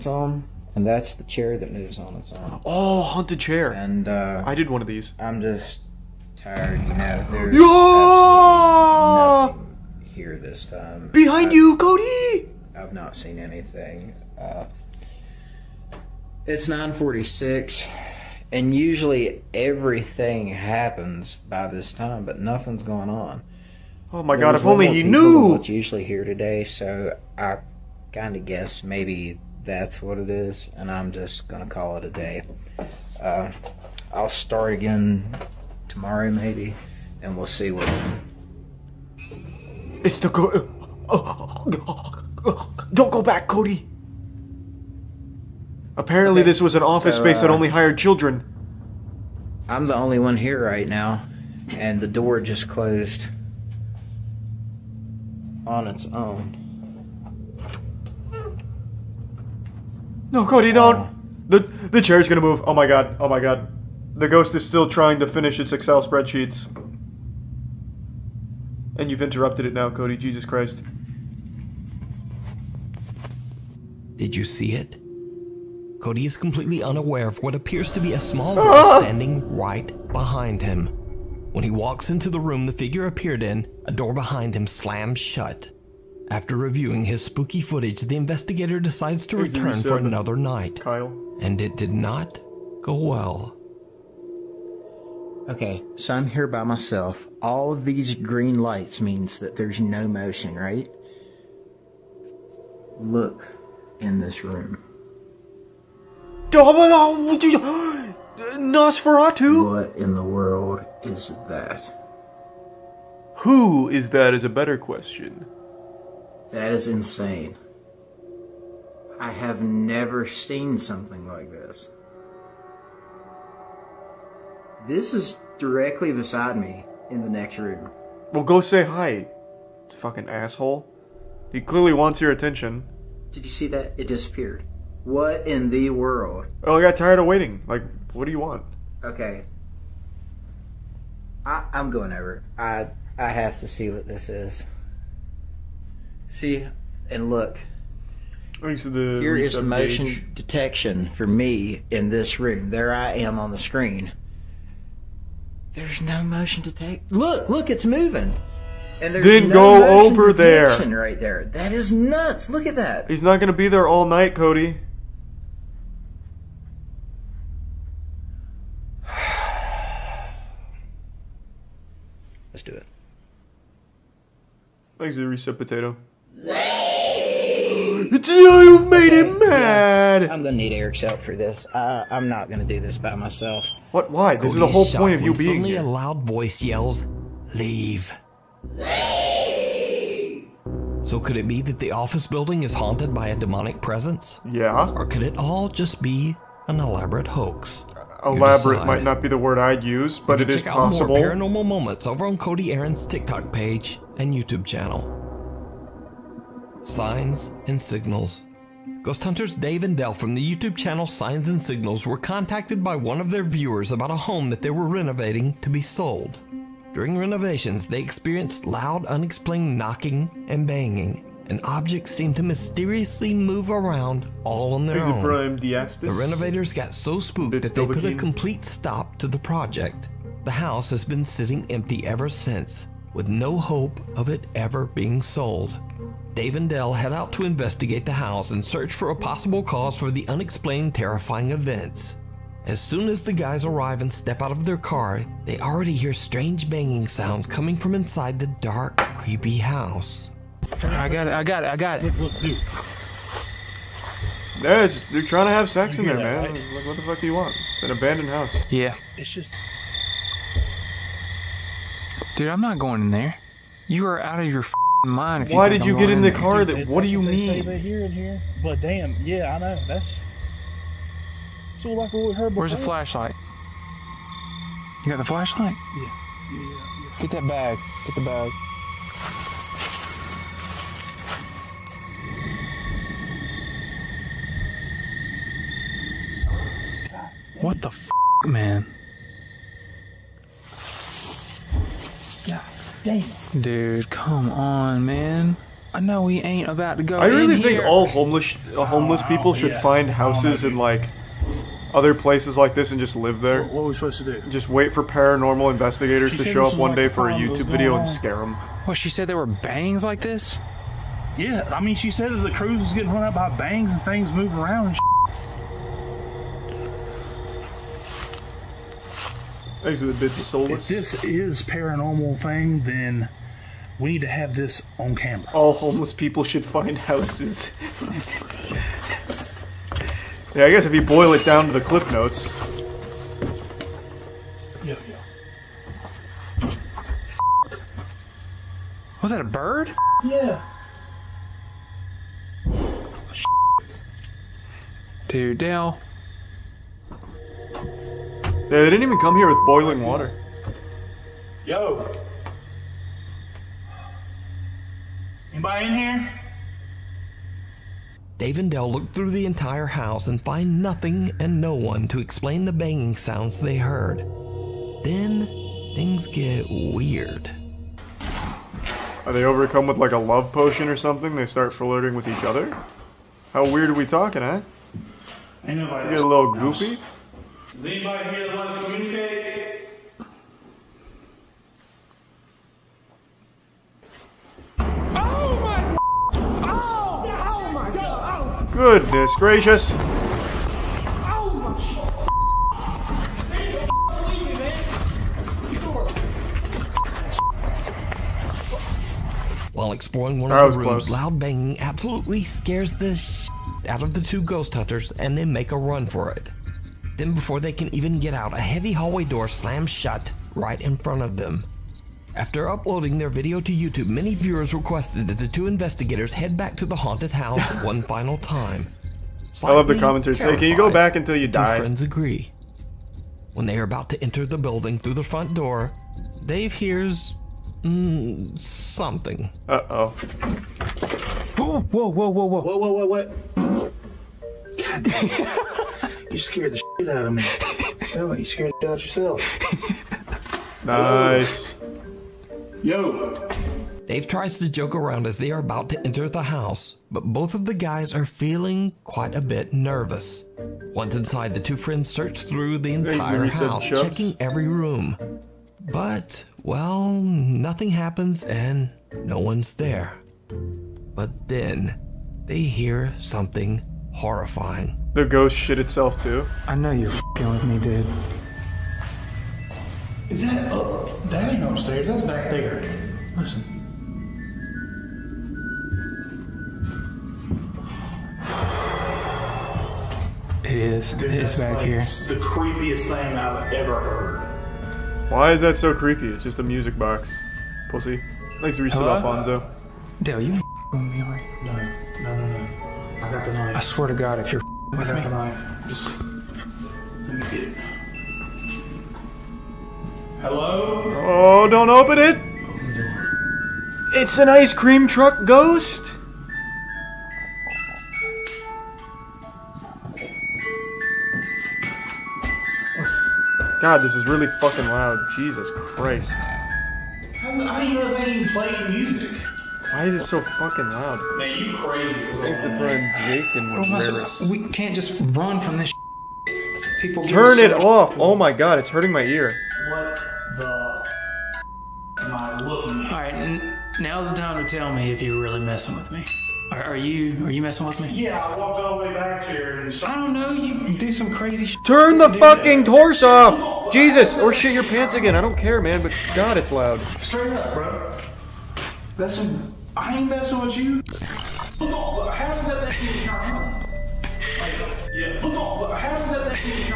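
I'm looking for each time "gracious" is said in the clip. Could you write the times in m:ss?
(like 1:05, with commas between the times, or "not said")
6:29.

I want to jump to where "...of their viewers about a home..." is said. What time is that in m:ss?
3:33.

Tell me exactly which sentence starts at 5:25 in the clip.
All homeless people should find houses.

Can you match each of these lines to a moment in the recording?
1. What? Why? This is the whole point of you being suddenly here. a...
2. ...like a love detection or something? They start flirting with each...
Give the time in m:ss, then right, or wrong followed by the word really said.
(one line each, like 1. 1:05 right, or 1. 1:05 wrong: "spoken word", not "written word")
1. 3:03 right
2. 6:09 wrong: "potion", not "detection".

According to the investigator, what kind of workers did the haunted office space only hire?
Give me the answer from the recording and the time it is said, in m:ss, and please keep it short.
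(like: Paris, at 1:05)
children, at 0:47.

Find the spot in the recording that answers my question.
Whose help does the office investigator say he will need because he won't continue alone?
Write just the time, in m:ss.
3:00.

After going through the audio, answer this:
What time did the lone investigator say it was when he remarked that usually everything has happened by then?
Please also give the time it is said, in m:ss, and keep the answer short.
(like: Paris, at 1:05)
9:46, at 0:16.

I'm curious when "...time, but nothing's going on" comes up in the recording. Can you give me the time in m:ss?
0:21.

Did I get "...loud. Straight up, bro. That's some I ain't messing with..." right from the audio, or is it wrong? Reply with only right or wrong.
right.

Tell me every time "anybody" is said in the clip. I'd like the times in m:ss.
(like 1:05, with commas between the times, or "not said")
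5:55, 6:17.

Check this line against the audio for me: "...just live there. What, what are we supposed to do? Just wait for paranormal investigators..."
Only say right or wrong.
right.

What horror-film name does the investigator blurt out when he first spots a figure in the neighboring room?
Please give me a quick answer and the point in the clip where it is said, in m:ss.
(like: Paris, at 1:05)
Nosferatu, at 1:48.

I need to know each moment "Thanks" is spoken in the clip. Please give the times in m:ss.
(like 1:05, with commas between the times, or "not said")
2:55, 8:08.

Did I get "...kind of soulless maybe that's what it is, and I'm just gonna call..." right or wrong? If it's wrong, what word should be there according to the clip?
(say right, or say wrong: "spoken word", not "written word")
wrong: "guess", not "soulless".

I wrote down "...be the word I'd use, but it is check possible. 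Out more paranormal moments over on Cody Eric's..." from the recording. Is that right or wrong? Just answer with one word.
wrong.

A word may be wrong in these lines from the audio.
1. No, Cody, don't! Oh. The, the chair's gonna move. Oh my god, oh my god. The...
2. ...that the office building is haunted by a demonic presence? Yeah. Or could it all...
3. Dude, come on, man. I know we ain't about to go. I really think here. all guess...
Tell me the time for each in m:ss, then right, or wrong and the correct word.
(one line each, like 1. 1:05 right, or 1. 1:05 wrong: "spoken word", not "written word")
1. 1:00 right
2. 3:11 right
3. 4:53 wrong: "homeless", not "guess".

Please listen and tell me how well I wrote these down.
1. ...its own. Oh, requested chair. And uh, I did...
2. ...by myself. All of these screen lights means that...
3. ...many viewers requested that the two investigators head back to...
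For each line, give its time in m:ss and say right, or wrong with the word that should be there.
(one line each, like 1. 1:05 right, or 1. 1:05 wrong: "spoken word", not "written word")
1. 0:02 wrong: "haunted", not "requested"
2. 1:36 wrong: "green", not "screen"
3. 6:54 right.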